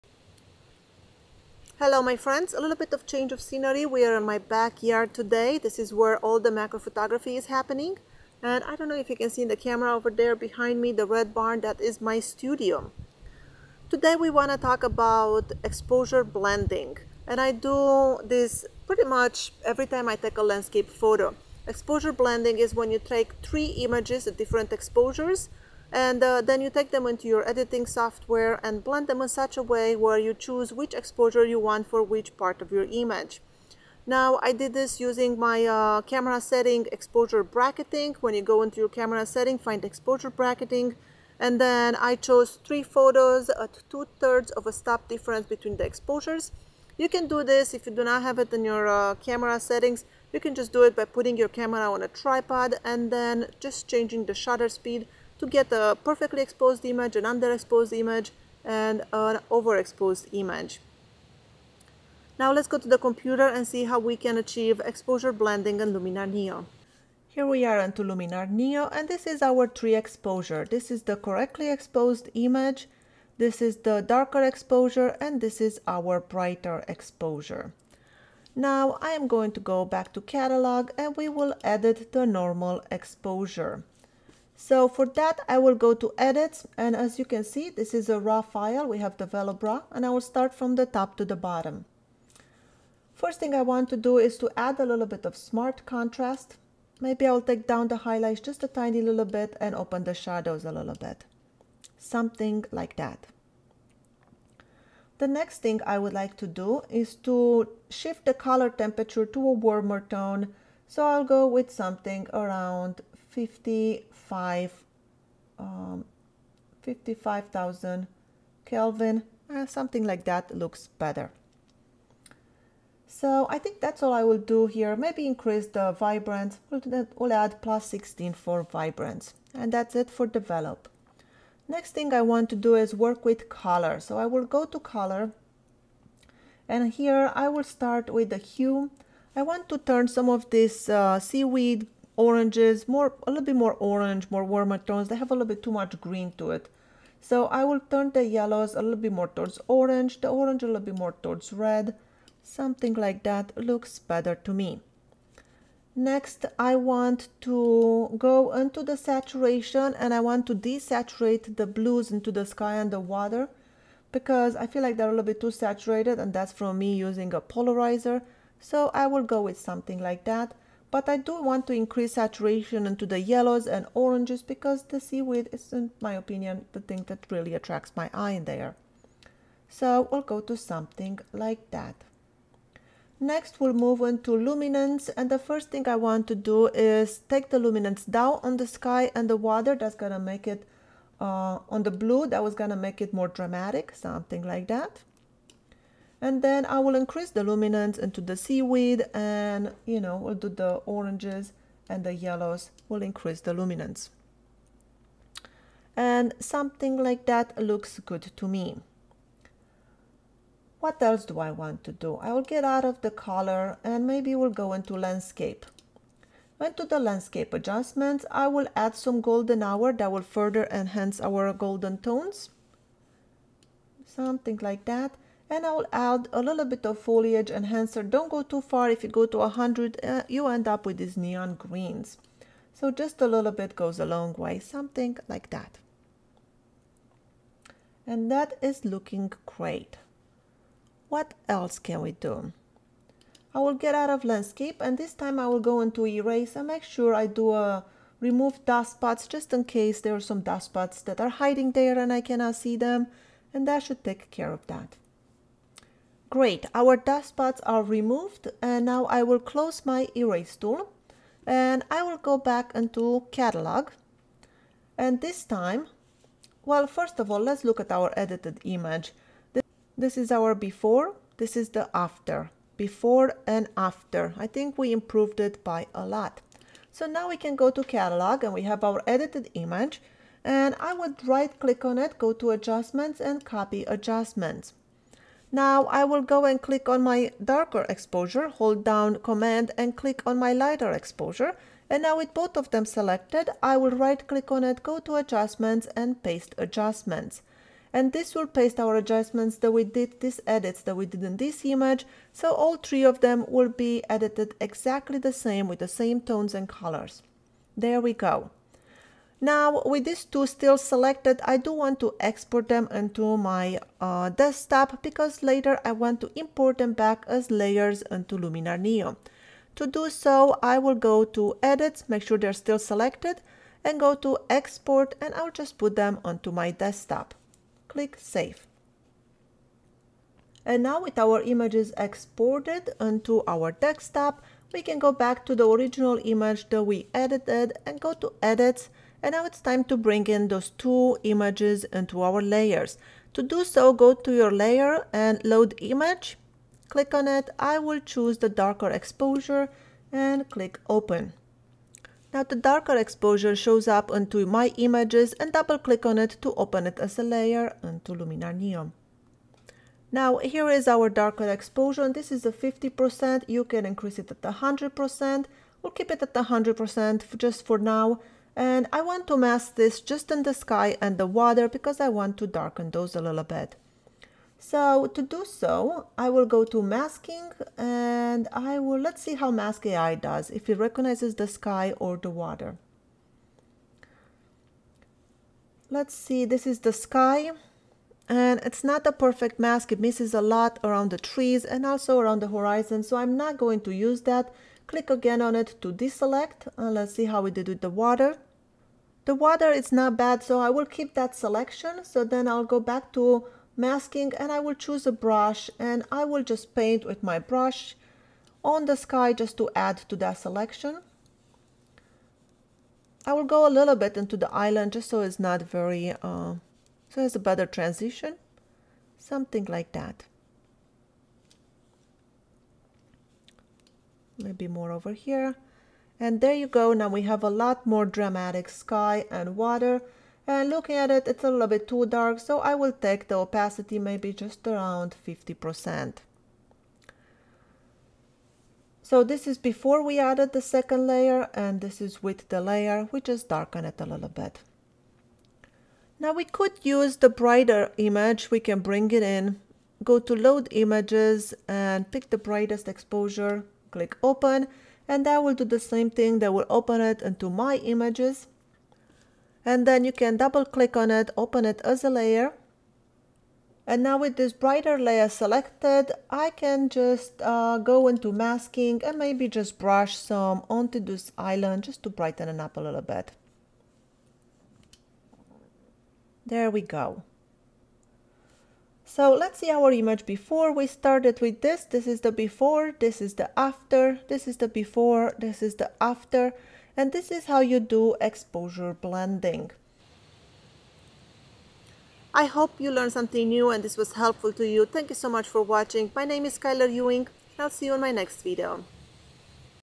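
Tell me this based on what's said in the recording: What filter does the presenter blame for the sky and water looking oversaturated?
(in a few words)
a polarizer.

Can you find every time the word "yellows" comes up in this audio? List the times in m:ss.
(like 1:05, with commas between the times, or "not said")
2:28, 2:53, 3:22.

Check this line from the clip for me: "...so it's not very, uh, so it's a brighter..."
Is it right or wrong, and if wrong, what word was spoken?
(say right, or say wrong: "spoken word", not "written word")
wrong: "better", not "brighter".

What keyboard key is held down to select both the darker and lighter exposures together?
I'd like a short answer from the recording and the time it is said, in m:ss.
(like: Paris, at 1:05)
command, at 4:49.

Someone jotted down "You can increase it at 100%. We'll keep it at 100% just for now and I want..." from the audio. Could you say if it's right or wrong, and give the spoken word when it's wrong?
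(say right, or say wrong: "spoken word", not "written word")
right.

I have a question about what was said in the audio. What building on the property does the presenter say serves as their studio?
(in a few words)
the red barn.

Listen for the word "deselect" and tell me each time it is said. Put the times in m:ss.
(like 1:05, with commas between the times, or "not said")
6:35.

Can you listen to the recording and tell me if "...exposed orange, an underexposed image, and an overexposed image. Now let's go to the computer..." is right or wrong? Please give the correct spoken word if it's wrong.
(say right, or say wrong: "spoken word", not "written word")
wrong: "image", not "orange".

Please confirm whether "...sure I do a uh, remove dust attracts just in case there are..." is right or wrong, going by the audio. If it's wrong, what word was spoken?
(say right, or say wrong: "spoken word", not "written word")
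wrong: "spots", not "attracts".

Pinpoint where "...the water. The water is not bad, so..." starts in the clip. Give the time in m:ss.
6:37.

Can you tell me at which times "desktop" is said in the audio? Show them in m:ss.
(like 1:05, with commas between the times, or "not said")
5:14, 5:26, 5:33.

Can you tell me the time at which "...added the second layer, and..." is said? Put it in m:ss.
7:20.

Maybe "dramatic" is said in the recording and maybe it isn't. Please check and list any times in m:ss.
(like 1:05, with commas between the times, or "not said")
3:13, 7:08.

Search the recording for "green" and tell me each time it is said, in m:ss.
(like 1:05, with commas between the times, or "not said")
2:26, 3:51.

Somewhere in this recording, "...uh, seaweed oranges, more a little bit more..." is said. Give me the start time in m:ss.
2:20.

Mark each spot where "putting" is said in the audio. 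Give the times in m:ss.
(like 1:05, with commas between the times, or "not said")
0:51.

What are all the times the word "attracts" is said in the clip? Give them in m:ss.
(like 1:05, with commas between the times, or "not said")
2:57.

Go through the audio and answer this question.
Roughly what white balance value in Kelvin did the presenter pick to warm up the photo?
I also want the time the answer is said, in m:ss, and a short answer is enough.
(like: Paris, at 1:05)
5500, at 1:53.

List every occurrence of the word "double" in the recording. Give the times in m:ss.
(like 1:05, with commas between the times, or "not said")
5:55, 7:40.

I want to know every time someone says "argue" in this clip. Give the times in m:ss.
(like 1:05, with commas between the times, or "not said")
not said.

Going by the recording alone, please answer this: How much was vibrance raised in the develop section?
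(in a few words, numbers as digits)
+16.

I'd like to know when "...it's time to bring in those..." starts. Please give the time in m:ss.
5:39.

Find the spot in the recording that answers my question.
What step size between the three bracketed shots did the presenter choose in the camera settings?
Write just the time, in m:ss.
0:43.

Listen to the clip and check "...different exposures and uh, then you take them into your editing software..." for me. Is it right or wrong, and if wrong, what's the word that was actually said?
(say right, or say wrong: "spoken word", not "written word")
right.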